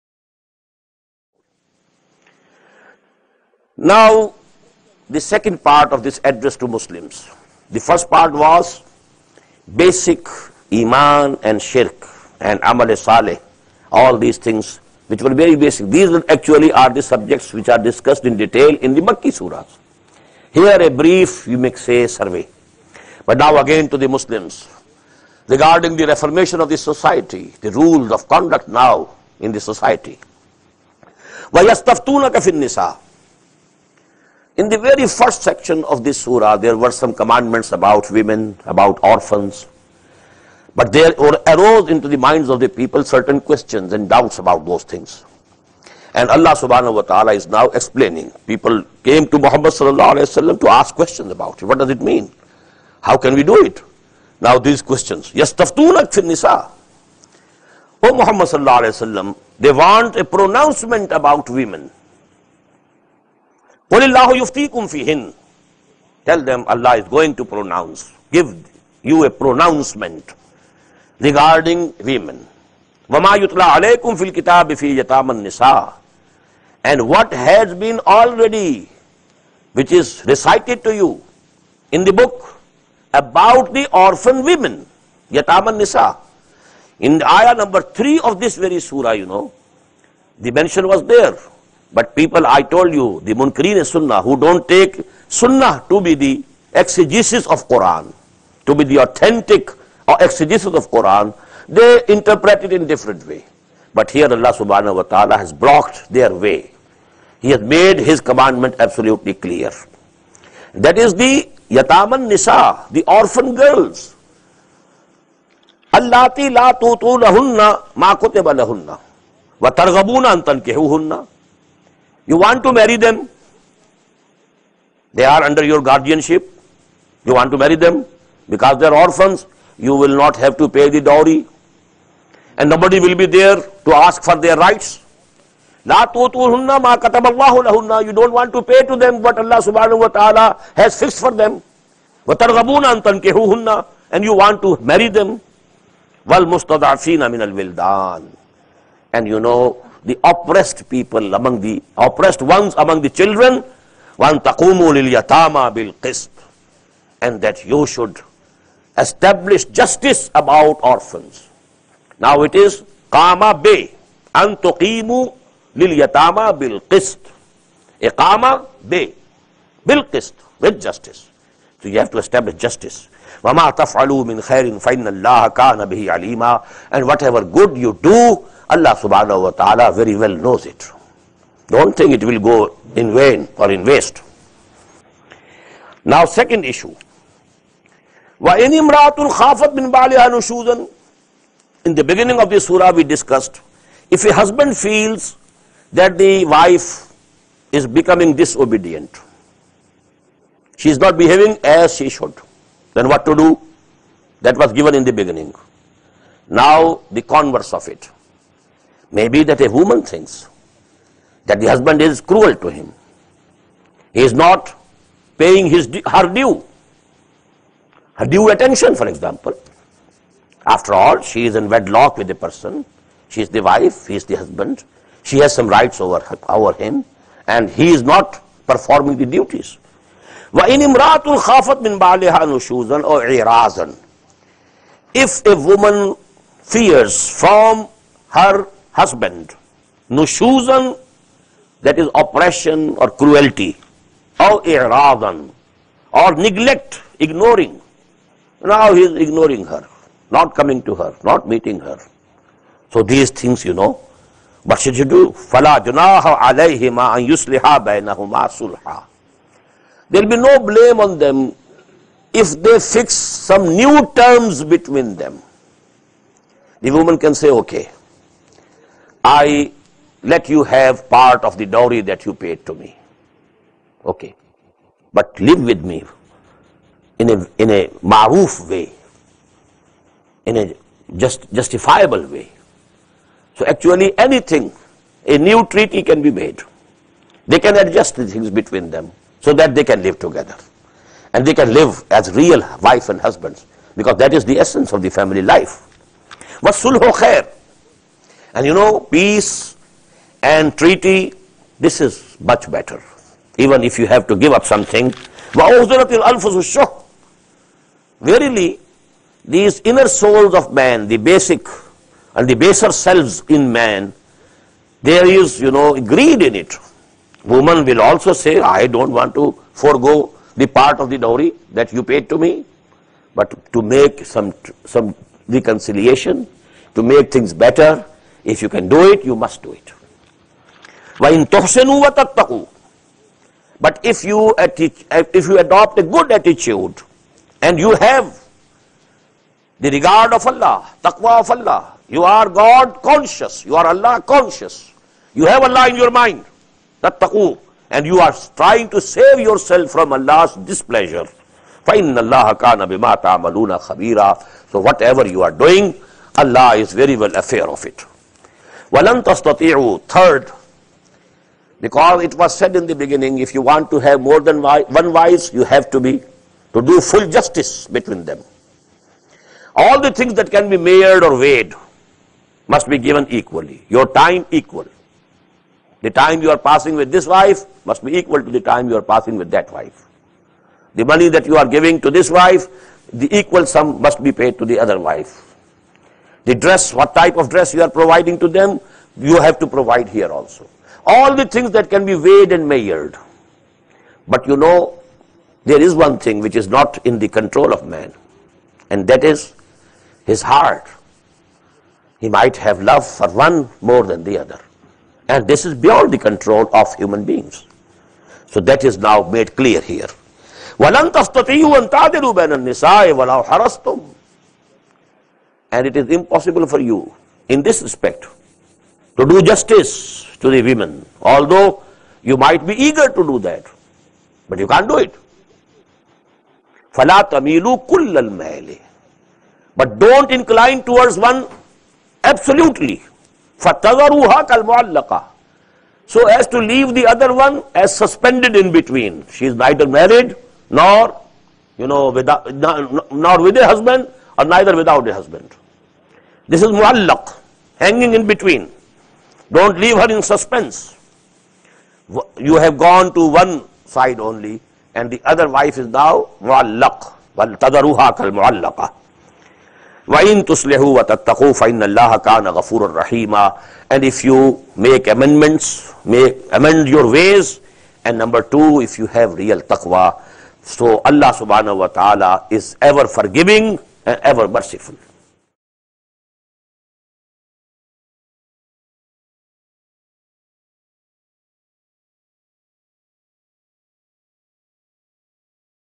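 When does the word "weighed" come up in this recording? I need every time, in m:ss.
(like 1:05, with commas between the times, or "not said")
6:11, 6:32.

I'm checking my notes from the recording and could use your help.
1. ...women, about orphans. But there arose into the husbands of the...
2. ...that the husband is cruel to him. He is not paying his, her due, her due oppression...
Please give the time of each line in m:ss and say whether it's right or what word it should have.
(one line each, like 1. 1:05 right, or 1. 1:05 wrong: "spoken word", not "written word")
1. 0:38 wrong: "minds", not "husbands"
2. 3:31 wrong: "attention", not "oppression".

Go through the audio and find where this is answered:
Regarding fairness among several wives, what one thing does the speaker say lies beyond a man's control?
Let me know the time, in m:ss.
6:40.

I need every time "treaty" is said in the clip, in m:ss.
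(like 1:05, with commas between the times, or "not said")
4:45, 5:00.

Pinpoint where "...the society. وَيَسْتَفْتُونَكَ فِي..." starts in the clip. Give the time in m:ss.
0:29.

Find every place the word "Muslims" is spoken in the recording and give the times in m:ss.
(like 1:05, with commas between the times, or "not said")
0:06, 0:24.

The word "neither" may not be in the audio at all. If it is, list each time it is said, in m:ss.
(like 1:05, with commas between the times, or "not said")
7:19, 7:24.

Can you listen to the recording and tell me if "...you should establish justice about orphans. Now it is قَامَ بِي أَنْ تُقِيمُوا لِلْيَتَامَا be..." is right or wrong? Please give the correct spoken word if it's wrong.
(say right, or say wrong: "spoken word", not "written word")
right.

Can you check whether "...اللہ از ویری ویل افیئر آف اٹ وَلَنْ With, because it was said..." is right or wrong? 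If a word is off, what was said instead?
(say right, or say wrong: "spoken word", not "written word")
wrong: "Third", not "With".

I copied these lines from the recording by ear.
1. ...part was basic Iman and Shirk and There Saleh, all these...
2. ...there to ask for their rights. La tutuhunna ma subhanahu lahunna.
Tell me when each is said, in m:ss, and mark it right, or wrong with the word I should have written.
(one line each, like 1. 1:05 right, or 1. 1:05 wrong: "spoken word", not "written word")
1. 0:08 wrong: "Amal", not "There"
2. 2:13 wrong: "kataballahu", not "subhanahu".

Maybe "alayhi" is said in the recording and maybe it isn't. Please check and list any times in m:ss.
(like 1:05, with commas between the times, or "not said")
0:50, 0:58.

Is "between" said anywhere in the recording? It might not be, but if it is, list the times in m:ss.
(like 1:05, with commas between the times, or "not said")
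4:24, 4:48, 6:07, 7:18.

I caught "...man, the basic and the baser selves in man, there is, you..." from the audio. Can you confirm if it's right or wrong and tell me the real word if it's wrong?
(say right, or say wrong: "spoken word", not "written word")
right.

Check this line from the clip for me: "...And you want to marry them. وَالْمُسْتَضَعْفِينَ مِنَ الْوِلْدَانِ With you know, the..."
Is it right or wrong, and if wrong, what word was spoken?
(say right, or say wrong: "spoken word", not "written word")
wrong: "And", not "With".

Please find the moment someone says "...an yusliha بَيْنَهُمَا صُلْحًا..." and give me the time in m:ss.
4:17.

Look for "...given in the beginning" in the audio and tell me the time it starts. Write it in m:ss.
3:24.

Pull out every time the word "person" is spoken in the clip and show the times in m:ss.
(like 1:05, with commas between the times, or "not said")
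3:42.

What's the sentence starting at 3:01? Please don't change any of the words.
Don't think it will go in vain or in waste.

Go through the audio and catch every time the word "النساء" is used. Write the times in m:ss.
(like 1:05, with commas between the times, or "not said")
0:32, 6:52.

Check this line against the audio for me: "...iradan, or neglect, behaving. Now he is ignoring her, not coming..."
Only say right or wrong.
wrong.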